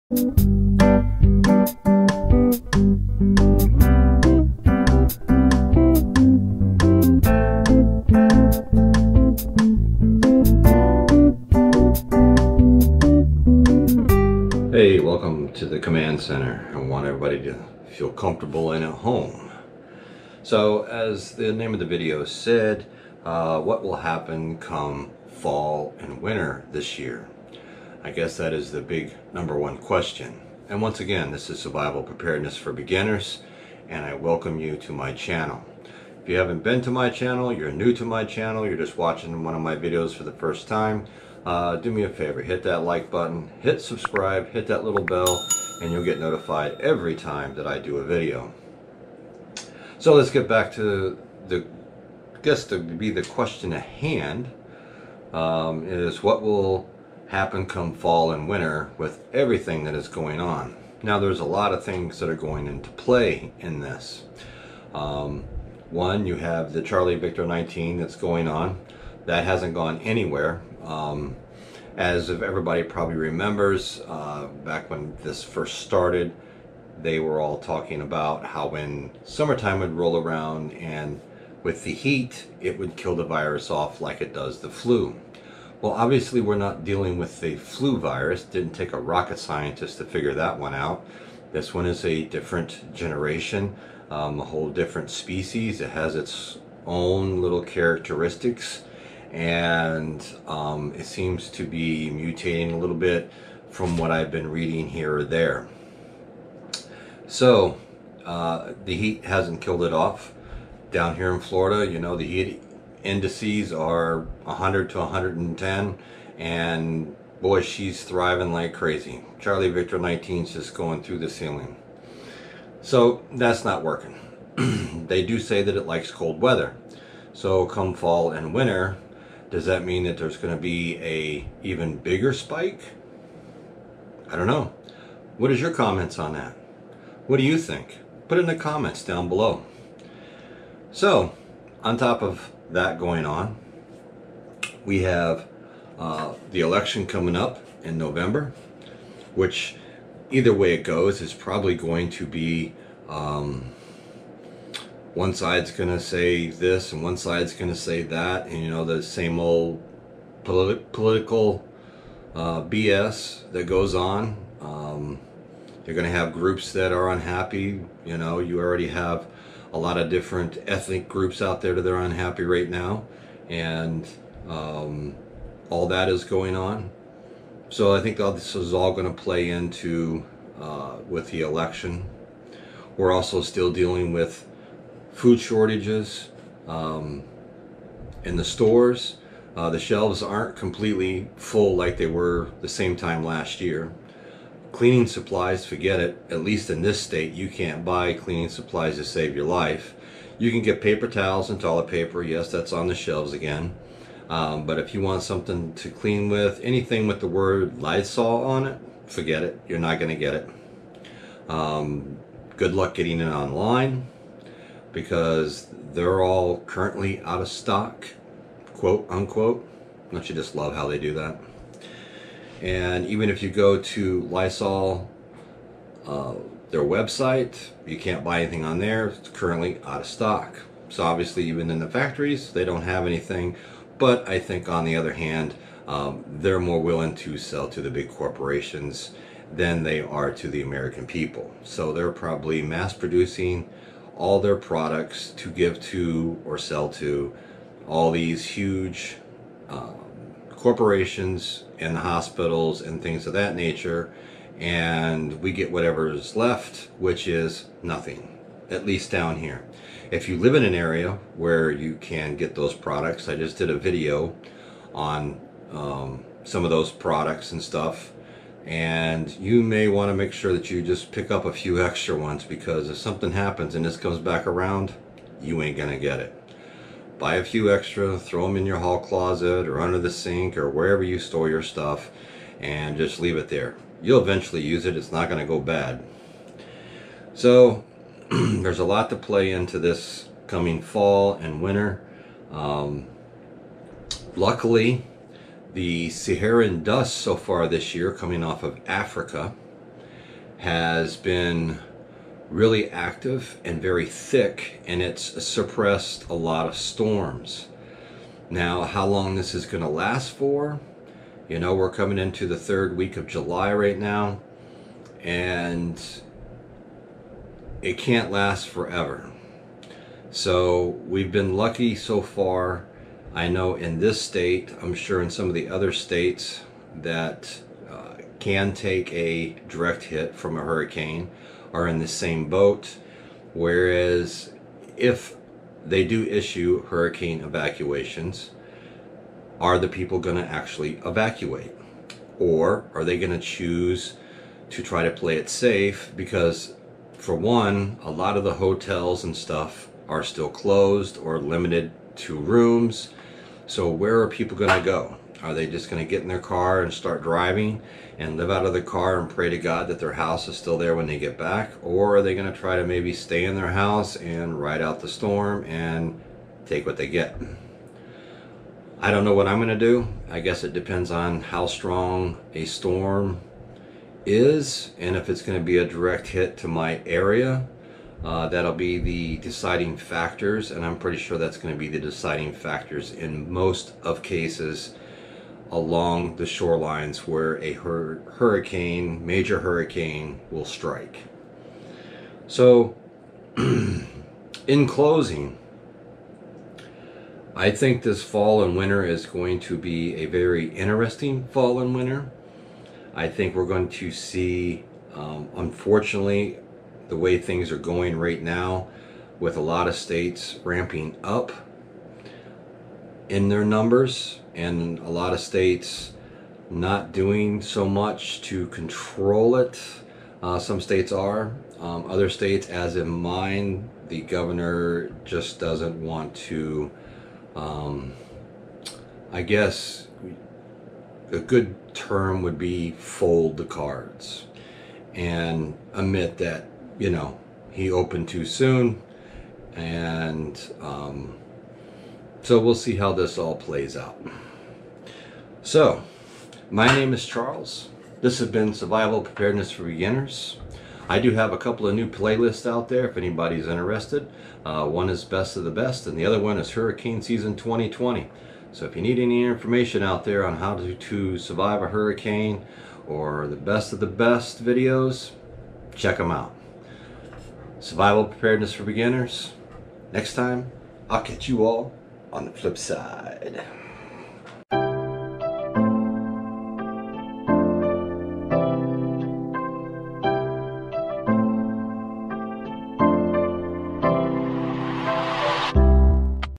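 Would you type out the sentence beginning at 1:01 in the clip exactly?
Now, there's a lot of things that are going into play in this.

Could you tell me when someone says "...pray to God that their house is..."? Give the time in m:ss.
5:59.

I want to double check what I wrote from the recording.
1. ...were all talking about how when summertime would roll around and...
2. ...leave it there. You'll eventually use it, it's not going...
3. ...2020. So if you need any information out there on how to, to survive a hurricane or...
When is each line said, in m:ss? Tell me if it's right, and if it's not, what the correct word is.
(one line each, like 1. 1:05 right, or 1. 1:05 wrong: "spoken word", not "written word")
1. 1:17 right
2. 4:43 right
3. 7:37 right.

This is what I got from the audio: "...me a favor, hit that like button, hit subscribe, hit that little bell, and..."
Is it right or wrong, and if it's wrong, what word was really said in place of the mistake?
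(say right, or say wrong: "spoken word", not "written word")
right.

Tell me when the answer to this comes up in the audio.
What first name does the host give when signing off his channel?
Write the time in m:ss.
7:27.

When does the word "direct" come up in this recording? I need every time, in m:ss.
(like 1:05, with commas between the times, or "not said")
5:29, 6:15.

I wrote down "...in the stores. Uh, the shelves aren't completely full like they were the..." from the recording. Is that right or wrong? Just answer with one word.
right.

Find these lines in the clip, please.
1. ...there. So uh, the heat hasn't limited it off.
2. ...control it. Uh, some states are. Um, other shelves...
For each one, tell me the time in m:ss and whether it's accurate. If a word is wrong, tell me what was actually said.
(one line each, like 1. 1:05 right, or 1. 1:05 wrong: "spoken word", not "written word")
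1. 1:45 wrong: "killed", not "limited"
2. 6:58 wrong: "states", not "shelves".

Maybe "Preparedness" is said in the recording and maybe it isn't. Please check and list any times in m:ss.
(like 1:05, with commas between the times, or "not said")
0:32, 7:29, 7:48.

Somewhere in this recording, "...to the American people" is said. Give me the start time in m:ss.
4:00.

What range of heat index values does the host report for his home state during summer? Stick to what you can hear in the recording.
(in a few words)
100 to 110.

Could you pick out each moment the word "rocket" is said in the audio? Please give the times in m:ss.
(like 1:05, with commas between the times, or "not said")
1:28.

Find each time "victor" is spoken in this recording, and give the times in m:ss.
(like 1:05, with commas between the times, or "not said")
1:07, 1:59.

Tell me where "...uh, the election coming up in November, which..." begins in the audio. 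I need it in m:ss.
2:25.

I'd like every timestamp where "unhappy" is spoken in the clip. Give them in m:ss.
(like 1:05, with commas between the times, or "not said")
2:47, 2:52.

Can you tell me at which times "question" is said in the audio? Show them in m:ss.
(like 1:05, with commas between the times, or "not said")
0:29, 0:53.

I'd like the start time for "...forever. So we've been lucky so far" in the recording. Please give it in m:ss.
5:18.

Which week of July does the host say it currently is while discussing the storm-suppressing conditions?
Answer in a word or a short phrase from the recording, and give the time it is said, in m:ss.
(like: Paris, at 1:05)
third week, at 5:12.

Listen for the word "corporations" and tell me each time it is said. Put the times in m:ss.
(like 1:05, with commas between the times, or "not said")
3:58, 4:10.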